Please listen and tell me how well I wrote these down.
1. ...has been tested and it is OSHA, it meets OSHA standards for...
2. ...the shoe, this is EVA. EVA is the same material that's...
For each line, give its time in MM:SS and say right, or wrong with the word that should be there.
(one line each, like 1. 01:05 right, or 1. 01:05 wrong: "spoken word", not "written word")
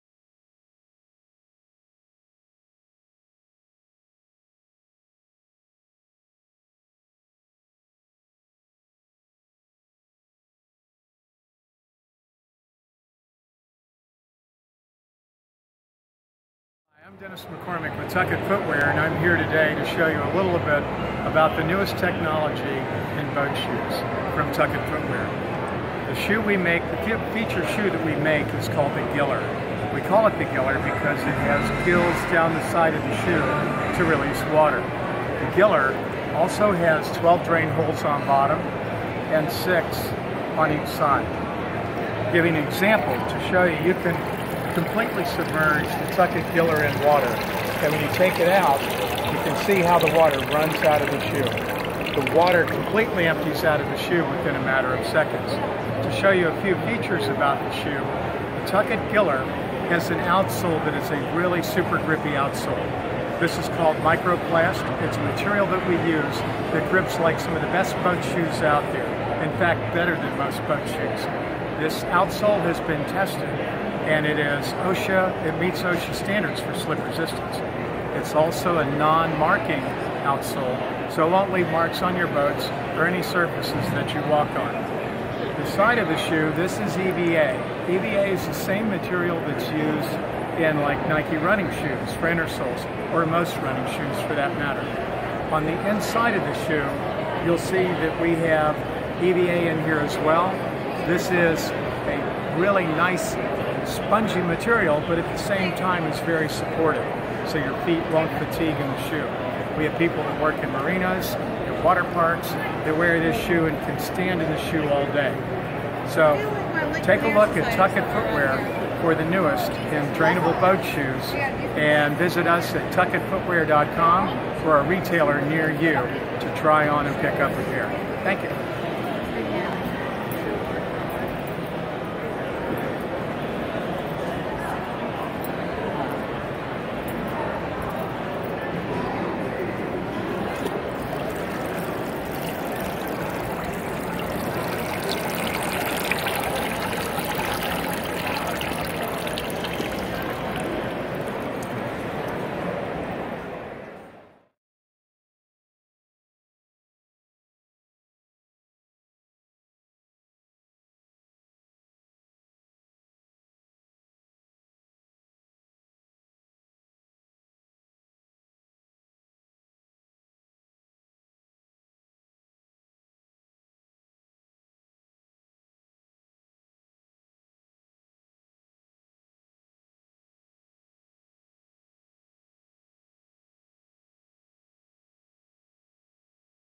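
1. 01:12 right
2. 01:26 right.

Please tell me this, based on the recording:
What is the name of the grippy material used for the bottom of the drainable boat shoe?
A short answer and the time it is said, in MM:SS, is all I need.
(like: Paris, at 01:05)
Microplast, at 01:03.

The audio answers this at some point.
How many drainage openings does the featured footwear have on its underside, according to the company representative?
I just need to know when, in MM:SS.
00:37.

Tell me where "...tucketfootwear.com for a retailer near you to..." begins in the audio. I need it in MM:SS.
02:02.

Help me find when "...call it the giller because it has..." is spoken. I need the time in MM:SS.
00:30.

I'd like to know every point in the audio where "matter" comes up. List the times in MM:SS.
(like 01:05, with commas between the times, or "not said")
00:54, 01:34.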